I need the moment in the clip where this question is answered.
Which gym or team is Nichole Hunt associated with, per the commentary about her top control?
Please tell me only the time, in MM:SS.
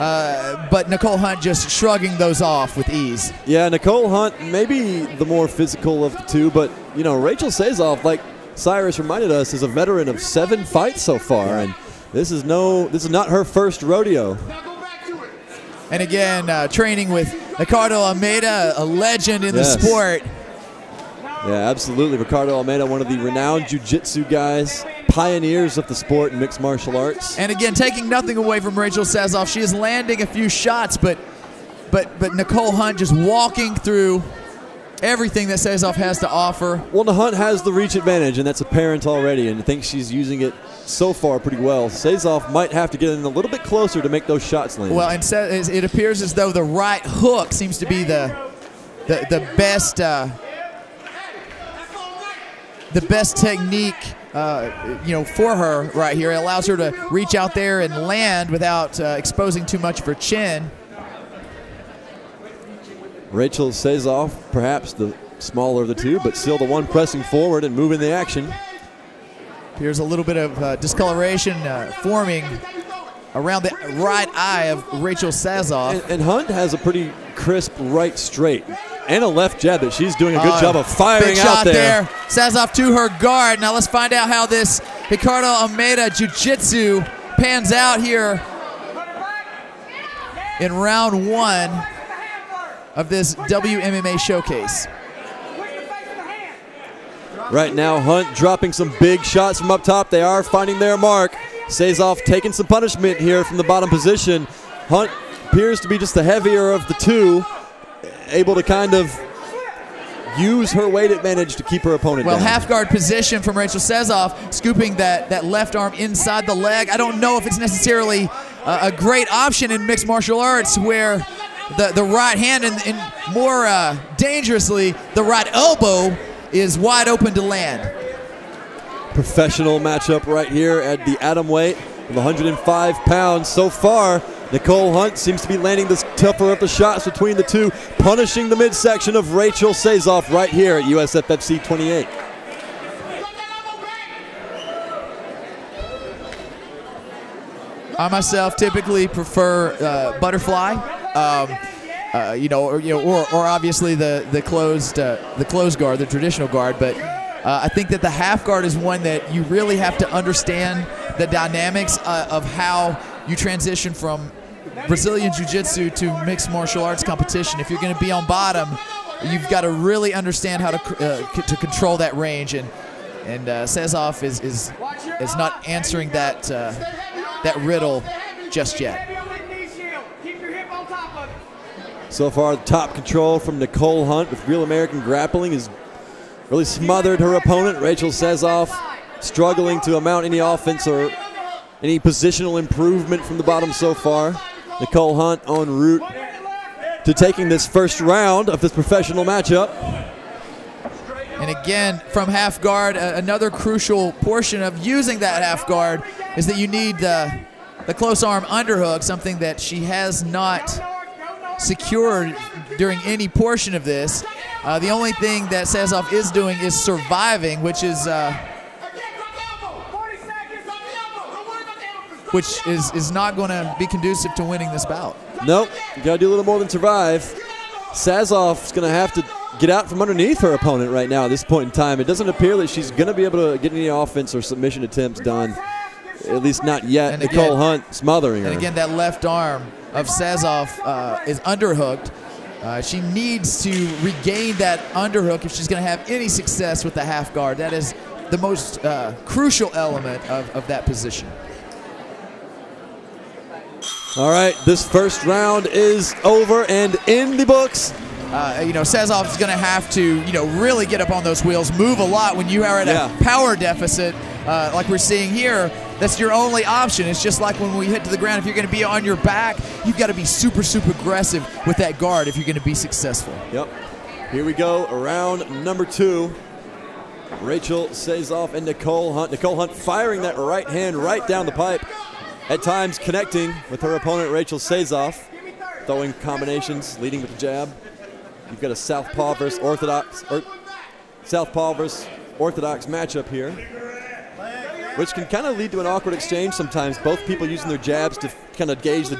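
03:04.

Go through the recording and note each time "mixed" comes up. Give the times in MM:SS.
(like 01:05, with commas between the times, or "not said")
00:26, 01:59, 02:46.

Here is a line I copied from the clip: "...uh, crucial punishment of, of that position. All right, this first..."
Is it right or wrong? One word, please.
wrong.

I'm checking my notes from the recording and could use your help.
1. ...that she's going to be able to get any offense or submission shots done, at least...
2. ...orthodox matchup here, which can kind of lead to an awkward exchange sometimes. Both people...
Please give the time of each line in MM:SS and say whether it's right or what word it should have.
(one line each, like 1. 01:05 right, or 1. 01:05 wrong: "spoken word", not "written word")
1. 03:52 wrong: "attempts", not "shots"
2. 04:52 right.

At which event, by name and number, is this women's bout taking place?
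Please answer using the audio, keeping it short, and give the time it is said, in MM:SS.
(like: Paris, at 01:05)
USFFC 28, at 02:20.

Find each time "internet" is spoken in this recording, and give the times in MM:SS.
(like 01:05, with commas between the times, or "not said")
not said.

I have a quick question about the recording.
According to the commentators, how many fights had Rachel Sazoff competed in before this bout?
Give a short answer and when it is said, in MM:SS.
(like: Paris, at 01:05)
7, at 00:10.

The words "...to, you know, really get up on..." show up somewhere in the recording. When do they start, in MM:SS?
04:19.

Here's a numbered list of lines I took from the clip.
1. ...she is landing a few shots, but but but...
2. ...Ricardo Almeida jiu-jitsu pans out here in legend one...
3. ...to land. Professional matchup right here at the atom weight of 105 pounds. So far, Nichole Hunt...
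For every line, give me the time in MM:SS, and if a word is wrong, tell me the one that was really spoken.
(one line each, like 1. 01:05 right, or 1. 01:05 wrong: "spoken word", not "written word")
1. 00:29 right
2. 01:25 wrong: "round", not "legend"
3. 02:07 right.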